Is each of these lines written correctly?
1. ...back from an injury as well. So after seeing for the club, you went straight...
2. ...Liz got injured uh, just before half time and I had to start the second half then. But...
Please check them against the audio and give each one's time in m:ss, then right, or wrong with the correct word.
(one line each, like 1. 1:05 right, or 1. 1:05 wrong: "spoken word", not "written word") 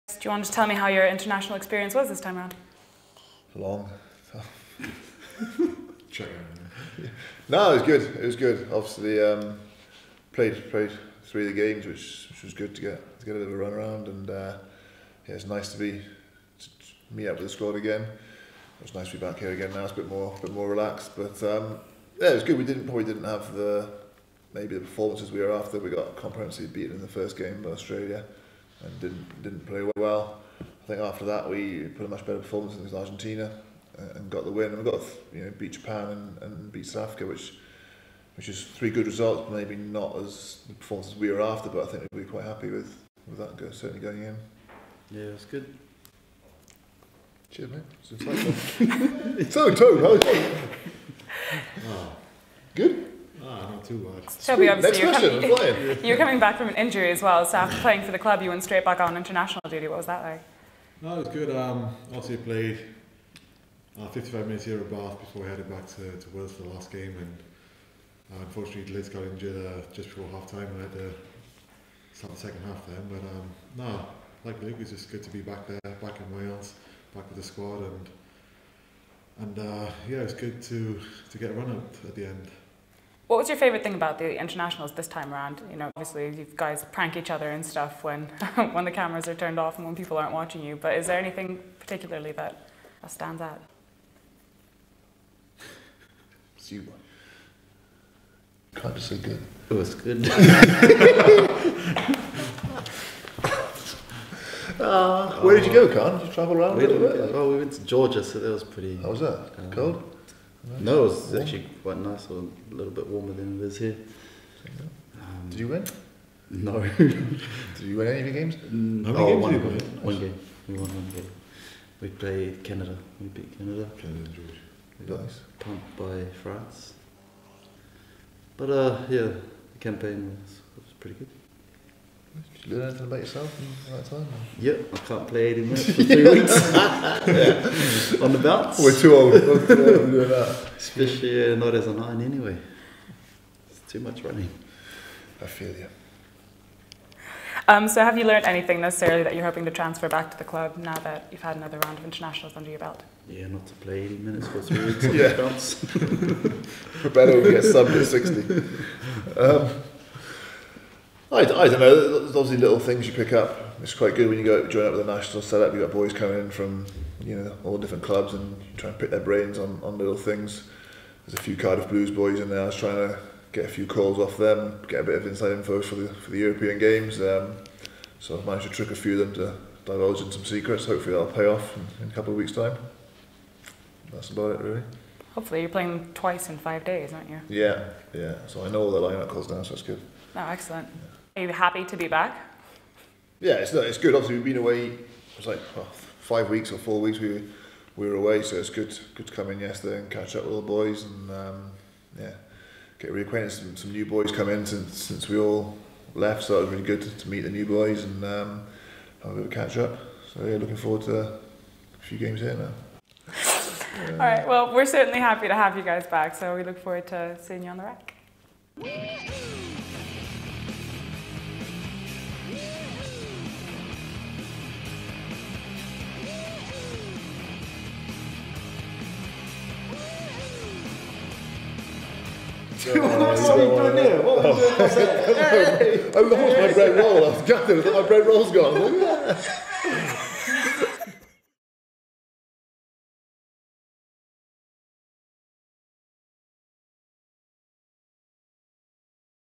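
1. 0:56 wrong: "playing", not "seeing"
2. 1:08 right.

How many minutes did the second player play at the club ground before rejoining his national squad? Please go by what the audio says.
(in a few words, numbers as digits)
55.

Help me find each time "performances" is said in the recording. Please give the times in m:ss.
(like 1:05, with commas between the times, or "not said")
0:24, 0:32, 0:40.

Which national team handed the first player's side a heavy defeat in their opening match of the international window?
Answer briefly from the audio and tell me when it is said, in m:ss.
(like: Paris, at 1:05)
Australia, at 0:27.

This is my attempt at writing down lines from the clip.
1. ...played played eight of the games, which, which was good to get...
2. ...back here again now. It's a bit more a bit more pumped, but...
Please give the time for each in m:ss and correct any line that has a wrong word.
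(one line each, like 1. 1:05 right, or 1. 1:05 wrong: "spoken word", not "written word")
1. 0:10 wrong: "three", not "eight"
2. 0:19 wrong: "relaxed", not "pumped".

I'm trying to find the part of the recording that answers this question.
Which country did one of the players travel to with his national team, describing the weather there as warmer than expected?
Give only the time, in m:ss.
1:47.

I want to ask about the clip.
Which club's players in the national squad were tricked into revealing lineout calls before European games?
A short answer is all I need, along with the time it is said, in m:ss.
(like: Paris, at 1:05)
Cardiff Blues, at 2:51.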